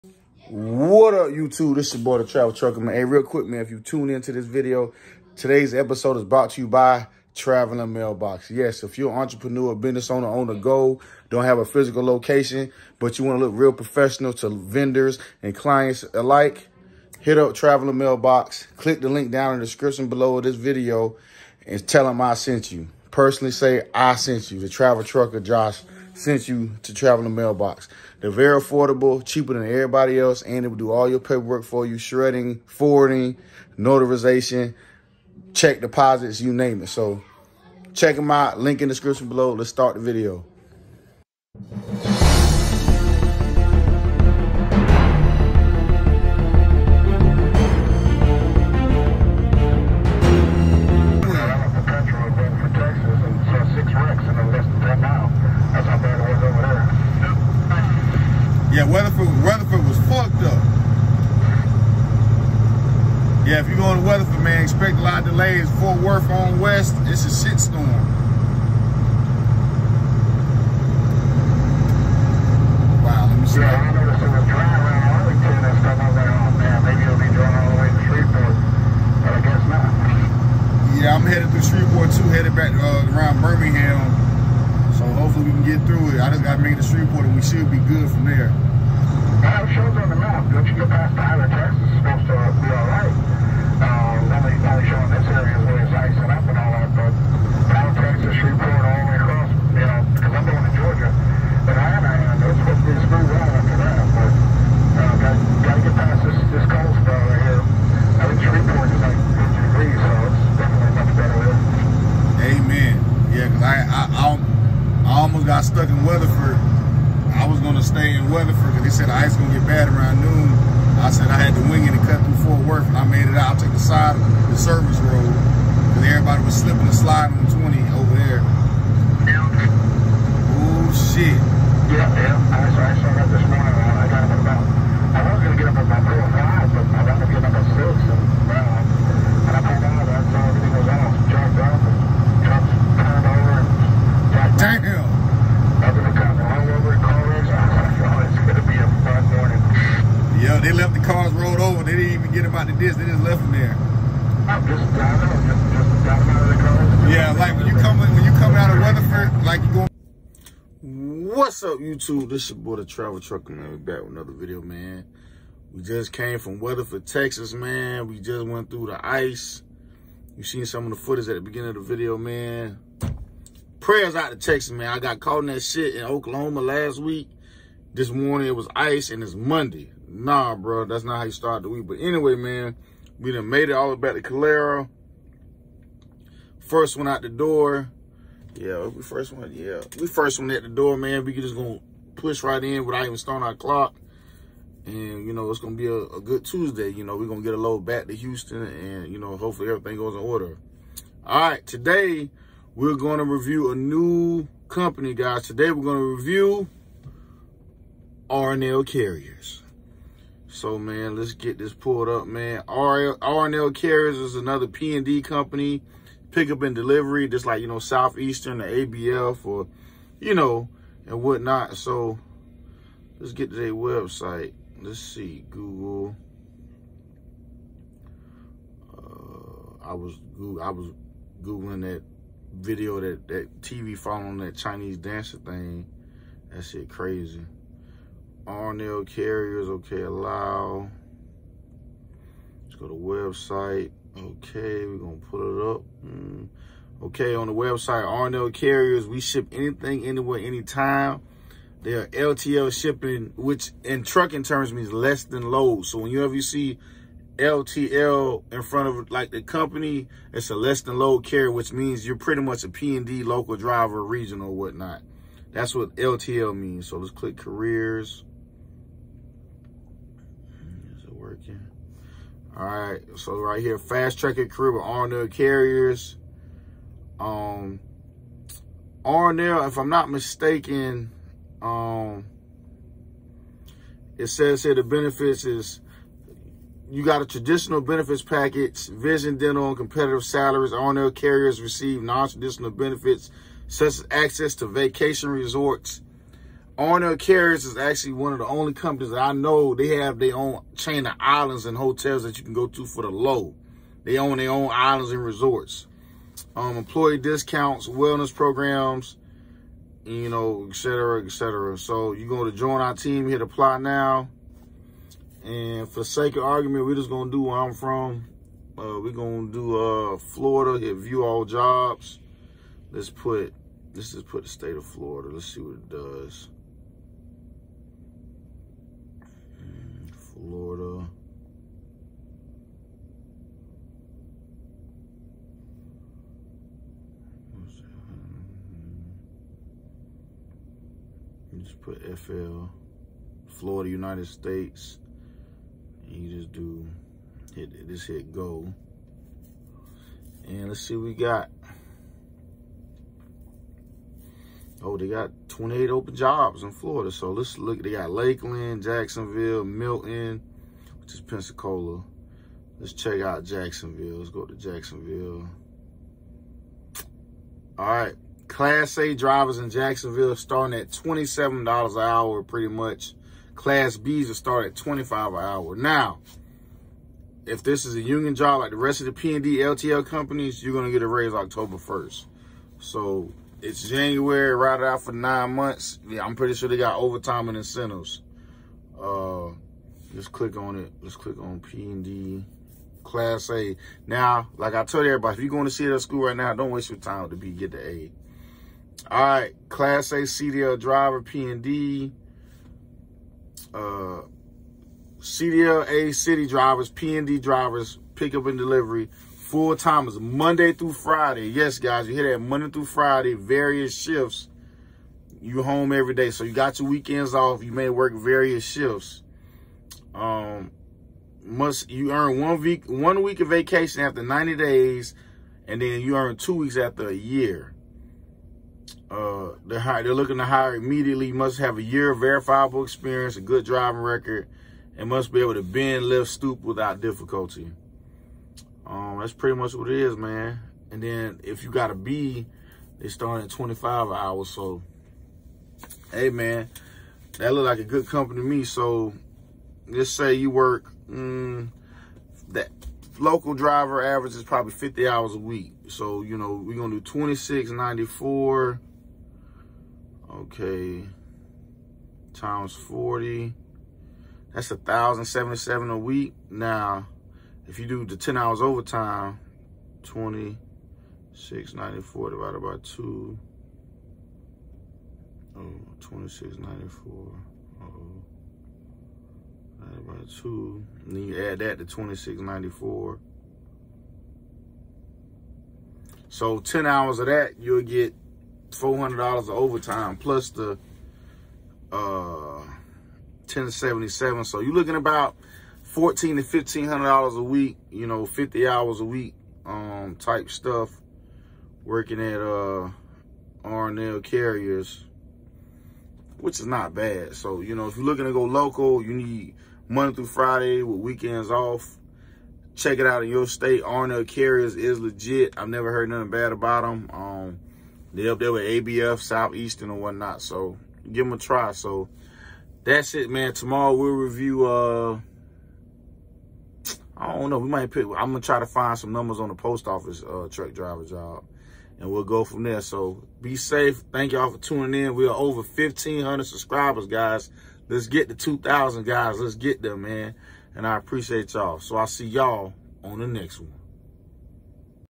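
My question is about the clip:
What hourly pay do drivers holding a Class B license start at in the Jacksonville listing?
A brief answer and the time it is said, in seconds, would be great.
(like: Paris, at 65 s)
$25 an hour, at 374 s.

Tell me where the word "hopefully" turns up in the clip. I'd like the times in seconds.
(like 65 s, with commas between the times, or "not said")
85 s, 199 s.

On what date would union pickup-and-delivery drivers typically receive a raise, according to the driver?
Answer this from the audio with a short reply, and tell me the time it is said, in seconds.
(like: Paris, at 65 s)
October 1st, at 381 s.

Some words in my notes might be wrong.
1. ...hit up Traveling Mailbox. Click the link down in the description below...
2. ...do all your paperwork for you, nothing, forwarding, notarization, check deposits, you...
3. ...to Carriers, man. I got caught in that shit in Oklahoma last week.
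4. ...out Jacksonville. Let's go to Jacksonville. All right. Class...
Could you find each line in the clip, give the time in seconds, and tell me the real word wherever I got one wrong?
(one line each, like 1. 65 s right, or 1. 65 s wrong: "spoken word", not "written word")
1. 17 s right
2. 30 s wrong: "shredding", not "nothing"
3. 174 s wrong: "Texas", not "Carriers"
4. 363 s right.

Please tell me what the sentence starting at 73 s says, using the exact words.
Yeah, I noticed it was dry around Arlington and stuff.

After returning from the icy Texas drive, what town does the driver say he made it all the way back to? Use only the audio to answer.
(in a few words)
Calera.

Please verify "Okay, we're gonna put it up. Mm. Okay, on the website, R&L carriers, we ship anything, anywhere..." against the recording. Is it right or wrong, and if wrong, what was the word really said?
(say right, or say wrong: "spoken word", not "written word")
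right.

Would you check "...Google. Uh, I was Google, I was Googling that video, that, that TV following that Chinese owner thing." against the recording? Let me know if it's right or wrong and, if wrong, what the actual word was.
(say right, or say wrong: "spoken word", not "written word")
wrong: "dancer", not "owner".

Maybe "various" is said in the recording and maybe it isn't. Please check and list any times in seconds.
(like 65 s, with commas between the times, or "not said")
413 s, 418 s.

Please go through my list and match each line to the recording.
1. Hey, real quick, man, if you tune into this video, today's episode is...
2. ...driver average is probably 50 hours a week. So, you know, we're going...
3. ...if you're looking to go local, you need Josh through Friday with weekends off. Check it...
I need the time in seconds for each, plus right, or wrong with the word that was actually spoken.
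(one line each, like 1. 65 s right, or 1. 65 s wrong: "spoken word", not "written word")
1. 2 s right
2. 453 s right
3. 507 s wrong: "Monday", not "Josh".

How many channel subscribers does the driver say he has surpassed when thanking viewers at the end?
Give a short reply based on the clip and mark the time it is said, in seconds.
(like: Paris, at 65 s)
1,500, at 535 s.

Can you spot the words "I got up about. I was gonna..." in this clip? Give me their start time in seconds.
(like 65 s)
133 s.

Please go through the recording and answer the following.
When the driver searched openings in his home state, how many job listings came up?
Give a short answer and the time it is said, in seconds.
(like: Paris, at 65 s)
28, at 355 s.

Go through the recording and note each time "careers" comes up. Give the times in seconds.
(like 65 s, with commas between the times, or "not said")
267 s, 274 s.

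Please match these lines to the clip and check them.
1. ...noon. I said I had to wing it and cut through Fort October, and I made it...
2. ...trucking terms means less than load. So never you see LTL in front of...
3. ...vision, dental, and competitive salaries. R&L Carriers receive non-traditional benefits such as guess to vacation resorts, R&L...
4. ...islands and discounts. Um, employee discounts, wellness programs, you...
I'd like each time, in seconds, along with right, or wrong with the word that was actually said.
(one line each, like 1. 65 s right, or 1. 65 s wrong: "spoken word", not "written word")
1. 120 s wrong: "Worth", not "October"
2. 254 s wrong: "whenever", not "never"
3. 288 s wrong: "access", not "guess"
4. 304 s wrong: "resorts", not "discounts".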